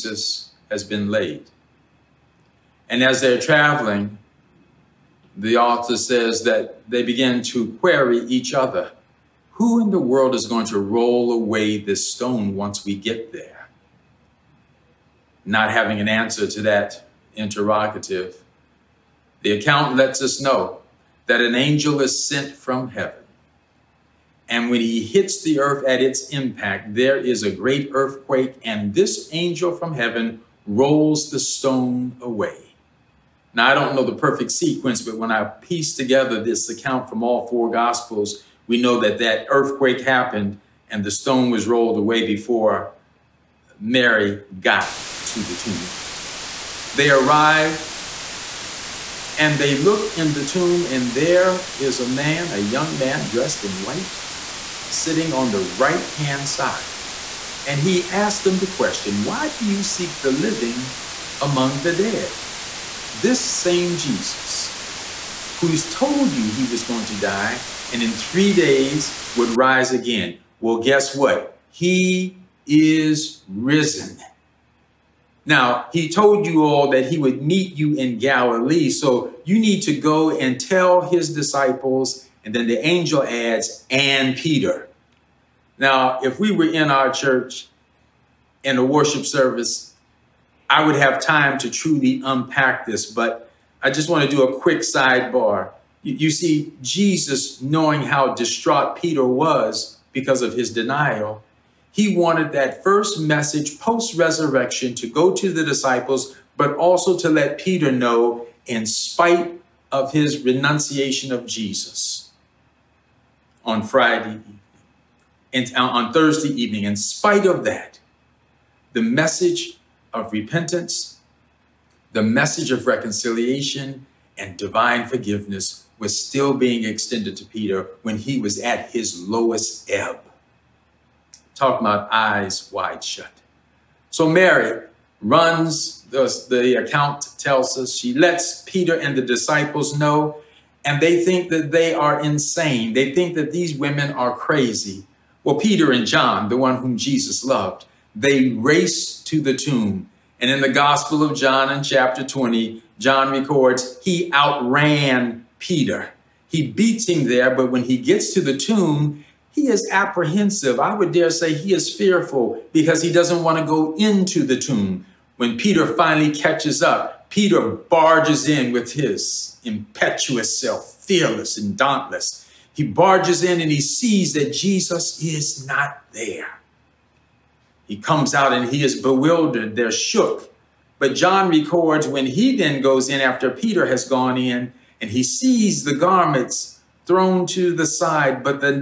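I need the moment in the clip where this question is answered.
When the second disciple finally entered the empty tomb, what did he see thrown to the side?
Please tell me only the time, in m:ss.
3:05.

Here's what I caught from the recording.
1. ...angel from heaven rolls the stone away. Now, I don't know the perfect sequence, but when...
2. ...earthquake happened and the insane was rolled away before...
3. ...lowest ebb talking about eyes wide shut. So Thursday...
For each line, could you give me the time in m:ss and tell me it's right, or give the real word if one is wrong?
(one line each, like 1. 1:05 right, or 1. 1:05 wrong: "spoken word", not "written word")
1. 0:29 right
2. 0:39 wrong: "stone", not "insane"
3. 2:09 wrong: "Mary", not "Thursday".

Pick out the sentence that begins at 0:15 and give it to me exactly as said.
Not having an answer to that interrogative.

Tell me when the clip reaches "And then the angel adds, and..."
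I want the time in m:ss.
1:22.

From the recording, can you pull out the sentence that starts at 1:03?
This same Jesus, who's told you he was going to die and in three days would rise again.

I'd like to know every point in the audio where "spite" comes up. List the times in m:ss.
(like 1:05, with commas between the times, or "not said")
1:48, 1:56.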